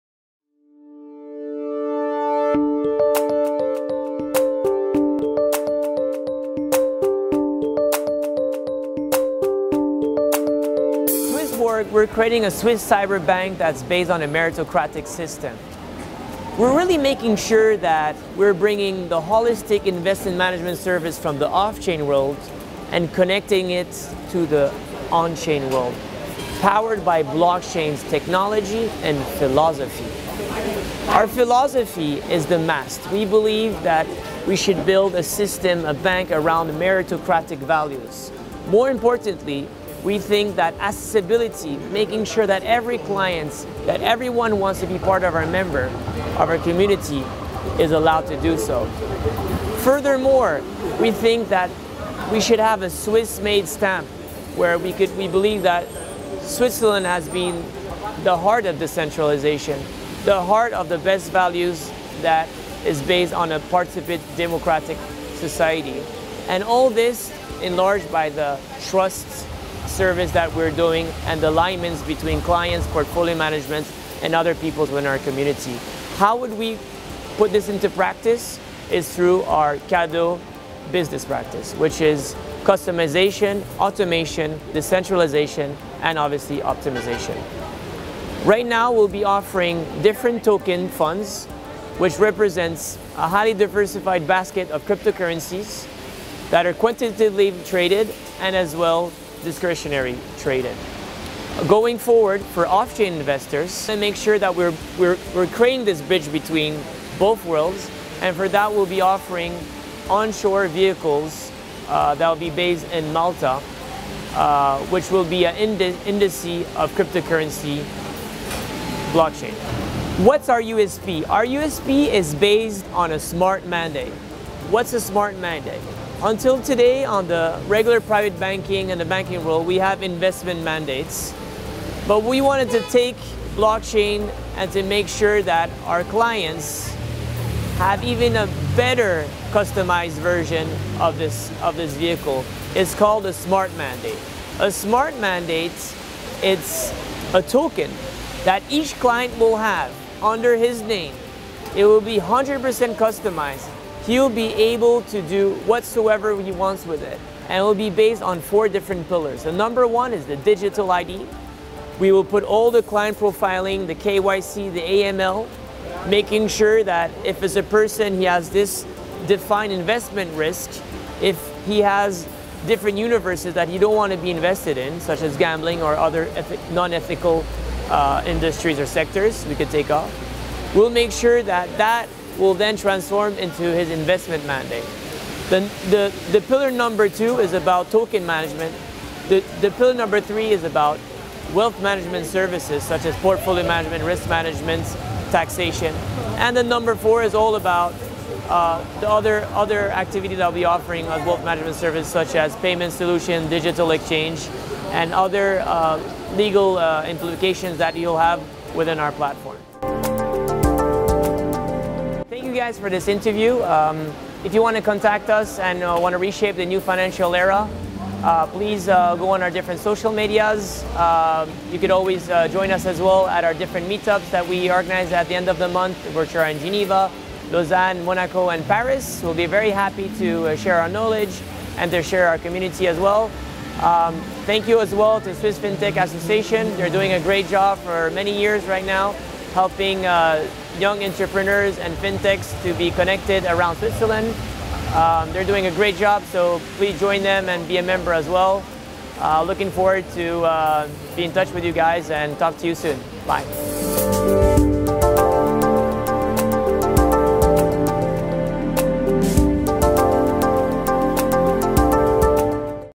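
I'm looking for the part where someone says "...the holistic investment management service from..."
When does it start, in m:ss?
0:19.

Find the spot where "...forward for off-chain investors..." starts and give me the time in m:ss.
1:41.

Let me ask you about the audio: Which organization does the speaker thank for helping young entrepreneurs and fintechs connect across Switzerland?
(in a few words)
Swiss FinTech Association.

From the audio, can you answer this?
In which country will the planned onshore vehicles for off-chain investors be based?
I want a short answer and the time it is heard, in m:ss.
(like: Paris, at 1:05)
Malta, at 1:53.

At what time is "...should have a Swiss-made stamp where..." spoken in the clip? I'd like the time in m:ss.
0:52.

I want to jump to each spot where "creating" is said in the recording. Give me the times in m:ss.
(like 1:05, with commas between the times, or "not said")
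0:12, 1:45.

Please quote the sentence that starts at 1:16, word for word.
How would we put this into practice?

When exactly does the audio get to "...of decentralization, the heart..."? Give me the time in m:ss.
0:58.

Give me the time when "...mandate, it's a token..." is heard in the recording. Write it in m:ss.
2:25.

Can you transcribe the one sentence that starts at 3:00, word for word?
We'll make sure that that will then transform into his investment mandate.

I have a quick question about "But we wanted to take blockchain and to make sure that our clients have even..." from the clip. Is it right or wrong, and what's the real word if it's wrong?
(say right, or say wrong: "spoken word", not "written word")
right.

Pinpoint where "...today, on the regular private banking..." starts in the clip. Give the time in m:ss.
2:06.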